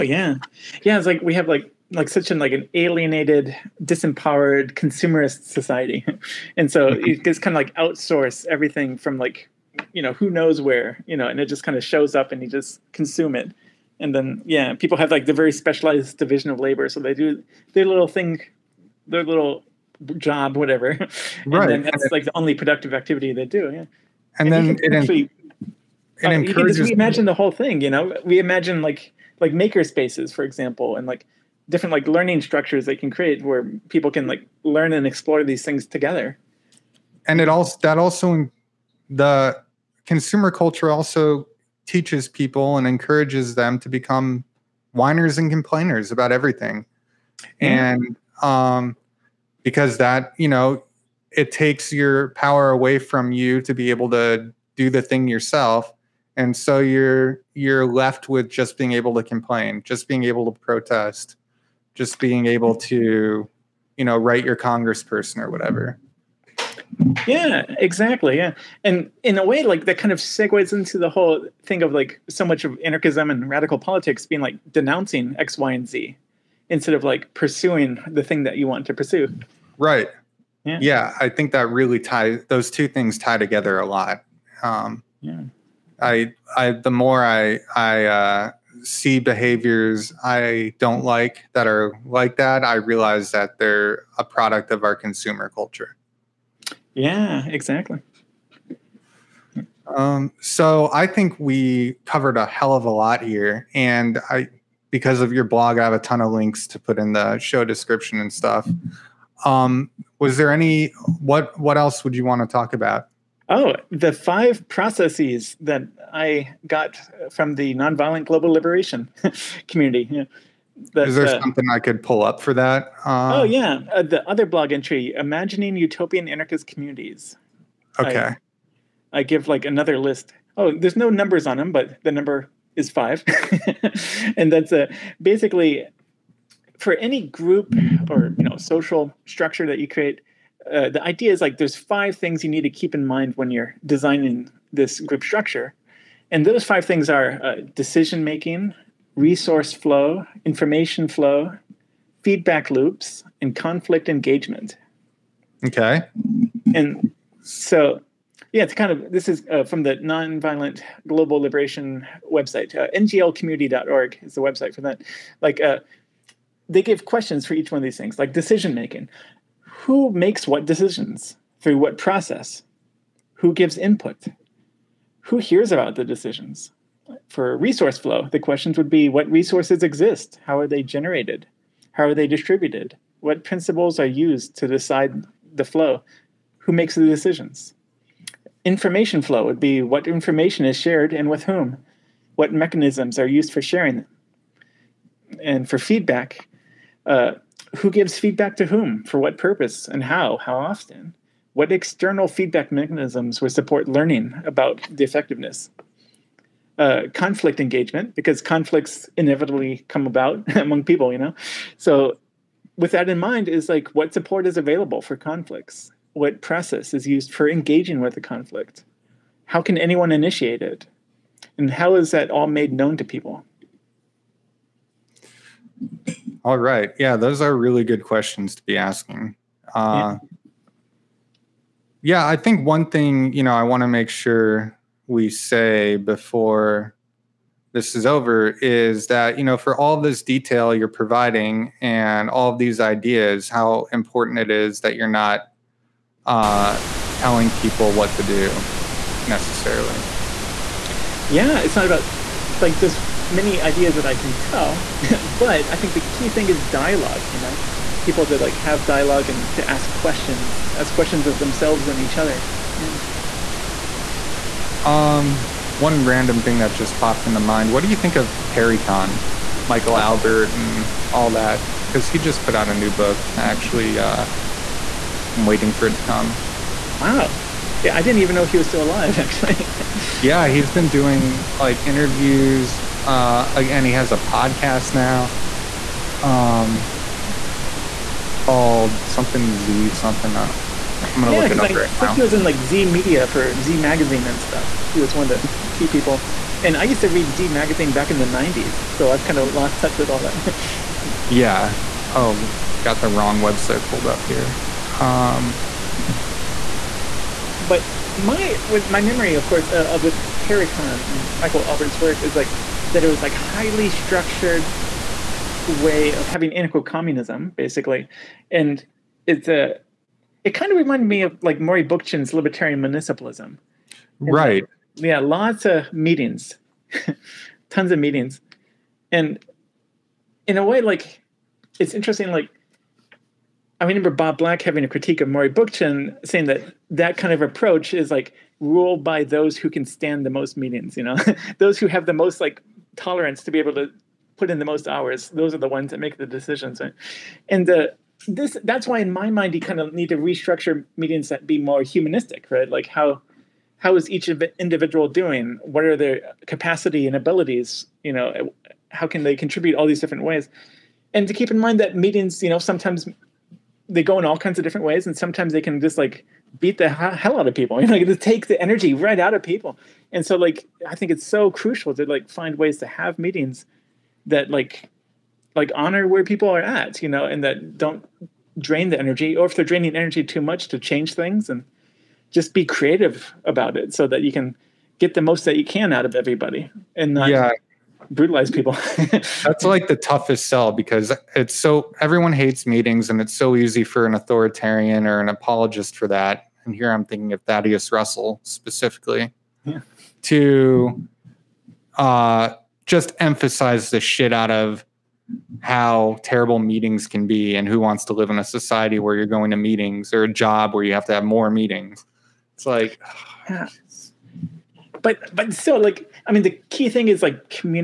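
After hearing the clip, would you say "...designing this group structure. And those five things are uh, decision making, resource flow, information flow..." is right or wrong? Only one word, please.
right.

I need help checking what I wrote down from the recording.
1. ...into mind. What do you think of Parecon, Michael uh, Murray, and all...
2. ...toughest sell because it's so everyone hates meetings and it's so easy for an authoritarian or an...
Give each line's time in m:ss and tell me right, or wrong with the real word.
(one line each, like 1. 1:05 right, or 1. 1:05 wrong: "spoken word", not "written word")
1. 4:27 wrong: "Albert", not "Murray"
2. 6:29 right.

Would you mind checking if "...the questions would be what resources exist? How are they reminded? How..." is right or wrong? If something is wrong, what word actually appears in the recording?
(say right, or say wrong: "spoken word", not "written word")
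wrong: "generated", not "reminded".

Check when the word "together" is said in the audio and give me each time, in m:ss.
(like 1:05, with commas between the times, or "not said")
0:35, 1:23.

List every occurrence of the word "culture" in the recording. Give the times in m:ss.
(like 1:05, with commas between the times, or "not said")
0:40, 1:35.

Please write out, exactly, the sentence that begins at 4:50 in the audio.
Uh, I'm gonna yeah, look it up I, right I think he was in like Z Media for Z Magazine and stuff.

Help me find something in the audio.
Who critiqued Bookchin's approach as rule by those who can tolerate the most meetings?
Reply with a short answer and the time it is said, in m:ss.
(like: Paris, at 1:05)
Bob Black, at 5:34.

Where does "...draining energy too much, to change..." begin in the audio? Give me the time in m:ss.
6:19.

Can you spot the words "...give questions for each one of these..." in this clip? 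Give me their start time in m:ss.
2:46.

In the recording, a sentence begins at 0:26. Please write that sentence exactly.
we imagine the whole thing, you know.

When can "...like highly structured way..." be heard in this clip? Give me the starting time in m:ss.
5:13.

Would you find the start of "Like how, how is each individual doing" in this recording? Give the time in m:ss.
5:52.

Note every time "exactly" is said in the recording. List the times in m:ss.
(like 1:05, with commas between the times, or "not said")
1:07, 1:37.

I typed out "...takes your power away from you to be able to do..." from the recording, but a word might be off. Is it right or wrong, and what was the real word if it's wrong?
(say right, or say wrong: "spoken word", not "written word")
right.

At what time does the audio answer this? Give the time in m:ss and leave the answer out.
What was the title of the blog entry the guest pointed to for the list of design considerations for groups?
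2:05.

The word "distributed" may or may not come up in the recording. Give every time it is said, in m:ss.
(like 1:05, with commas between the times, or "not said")
3:02.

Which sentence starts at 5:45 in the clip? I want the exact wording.
Those are the ones that make the decisions.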